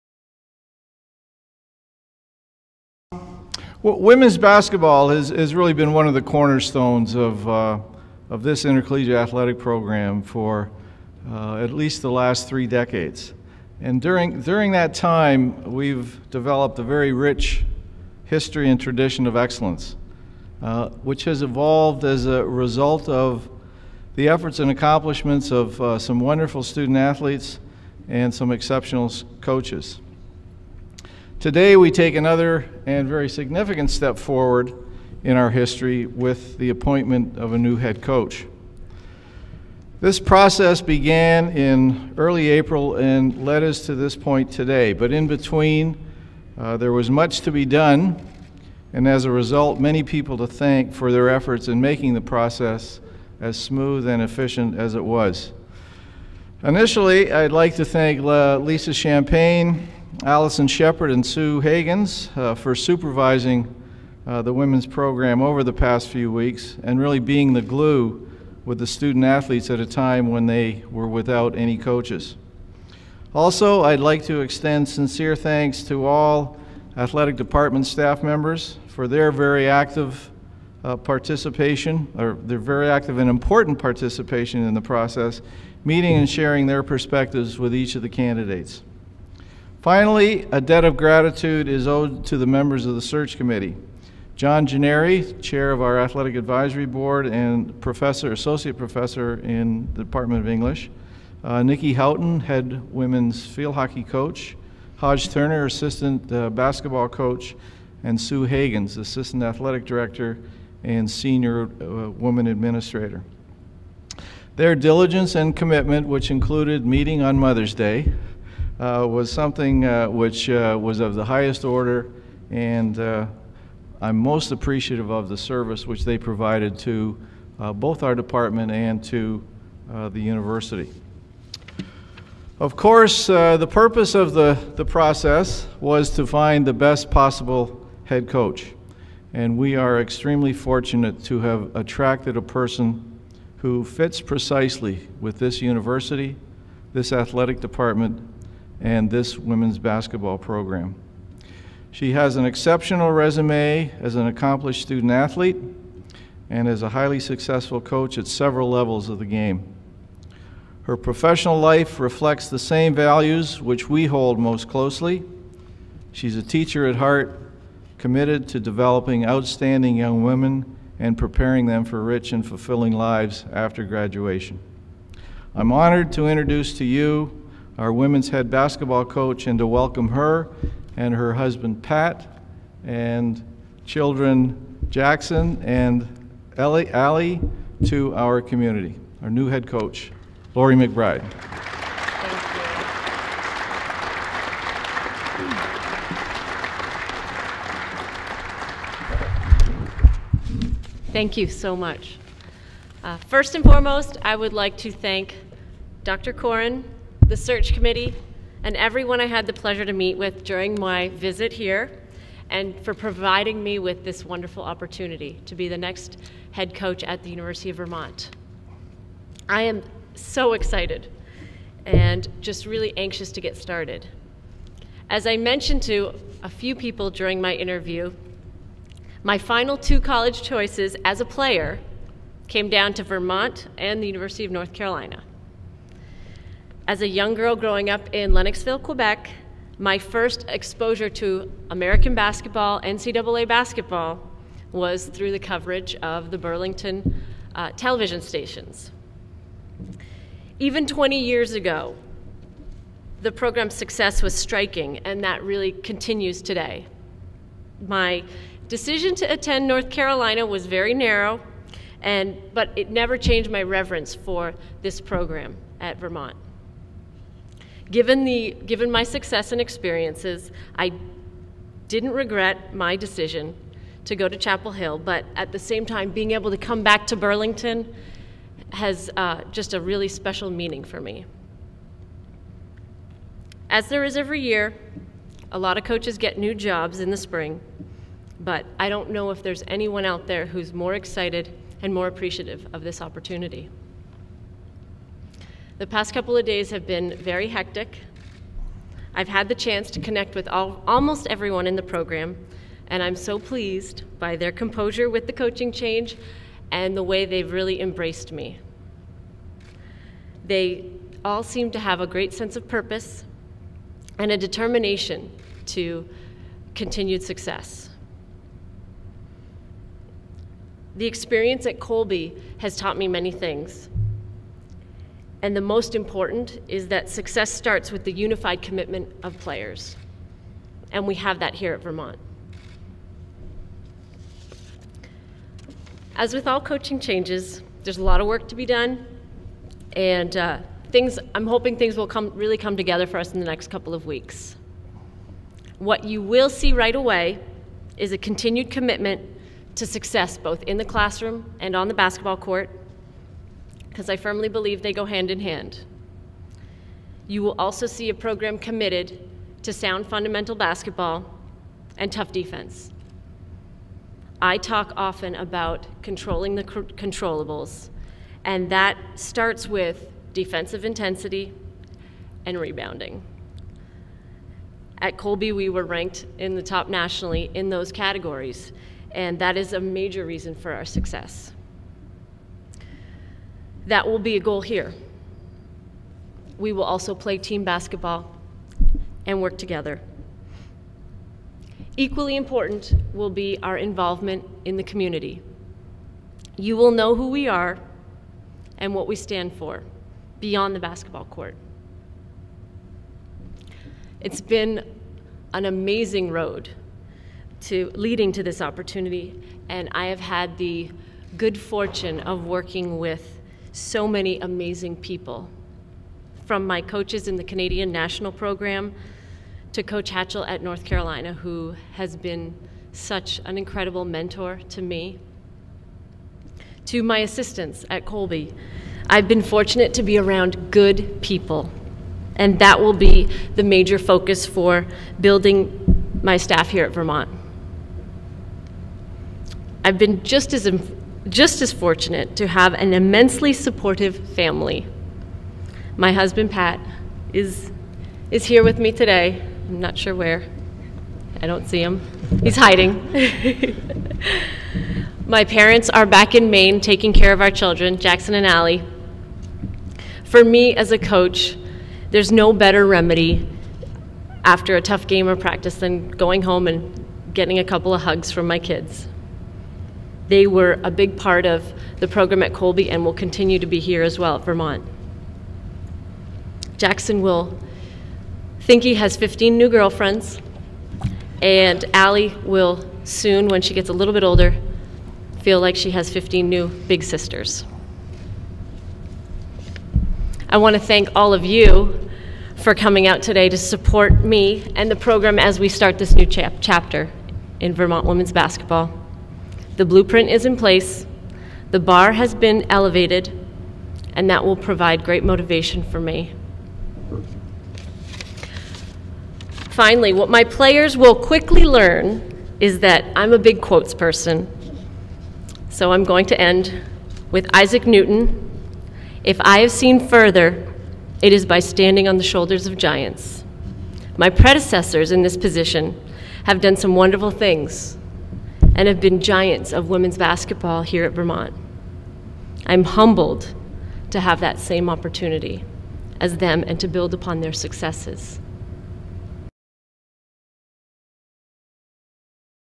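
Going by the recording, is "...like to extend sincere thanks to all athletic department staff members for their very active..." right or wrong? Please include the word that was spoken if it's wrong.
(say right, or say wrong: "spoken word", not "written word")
right.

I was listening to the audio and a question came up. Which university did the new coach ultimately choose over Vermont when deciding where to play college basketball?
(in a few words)
University of North Carolina.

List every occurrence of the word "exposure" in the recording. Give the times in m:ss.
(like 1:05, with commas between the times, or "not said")
4:00.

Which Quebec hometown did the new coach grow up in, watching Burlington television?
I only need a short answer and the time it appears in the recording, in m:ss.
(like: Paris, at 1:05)
Lennoxville, at 3:58.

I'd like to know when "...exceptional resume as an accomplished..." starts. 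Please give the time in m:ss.
2:32.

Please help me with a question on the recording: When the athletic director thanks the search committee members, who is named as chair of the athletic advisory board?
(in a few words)
John Gennari.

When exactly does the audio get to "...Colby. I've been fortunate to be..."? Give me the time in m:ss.
7:08.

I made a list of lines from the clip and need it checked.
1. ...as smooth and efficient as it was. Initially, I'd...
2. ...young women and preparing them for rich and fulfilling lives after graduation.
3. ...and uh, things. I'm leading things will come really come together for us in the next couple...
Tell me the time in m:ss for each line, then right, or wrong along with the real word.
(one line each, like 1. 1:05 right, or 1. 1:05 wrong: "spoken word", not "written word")
1. 0:53 right
2. 2:49 right
3. 5:39 wrong: "hoping", not "leading".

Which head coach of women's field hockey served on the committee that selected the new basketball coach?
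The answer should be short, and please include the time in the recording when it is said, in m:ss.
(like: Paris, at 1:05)
Nikki Houghton, at 1:41.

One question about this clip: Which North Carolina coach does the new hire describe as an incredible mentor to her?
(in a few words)
Coach Hatchell.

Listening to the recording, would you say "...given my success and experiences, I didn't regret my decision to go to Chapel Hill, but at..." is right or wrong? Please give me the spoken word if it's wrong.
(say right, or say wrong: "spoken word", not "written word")
right.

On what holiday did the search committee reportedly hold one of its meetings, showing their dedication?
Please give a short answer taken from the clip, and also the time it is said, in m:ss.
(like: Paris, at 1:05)
Mother's Day, at 1:57.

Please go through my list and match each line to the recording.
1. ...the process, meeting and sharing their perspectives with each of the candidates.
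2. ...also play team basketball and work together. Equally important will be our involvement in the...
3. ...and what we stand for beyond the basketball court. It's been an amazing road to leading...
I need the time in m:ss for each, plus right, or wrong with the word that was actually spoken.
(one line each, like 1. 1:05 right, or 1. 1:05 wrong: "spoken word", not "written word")
1. 1:24 right
2. 6:26 right
3. 6:38 right.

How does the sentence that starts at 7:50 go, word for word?
They were a big part of the program at Colby and will continue to be here as well at Vermont.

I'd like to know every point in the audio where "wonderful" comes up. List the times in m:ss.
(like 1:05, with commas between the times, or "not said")
0:26, 3:34, 8:46.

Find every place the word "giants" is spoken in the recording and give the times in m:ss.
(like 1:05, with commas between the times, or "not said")
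8:42, 8:49.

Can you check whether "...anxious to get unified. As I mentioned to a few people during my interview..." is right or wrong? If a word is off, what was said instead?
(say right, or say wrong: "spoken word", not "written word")
wrong: "started", not "unified".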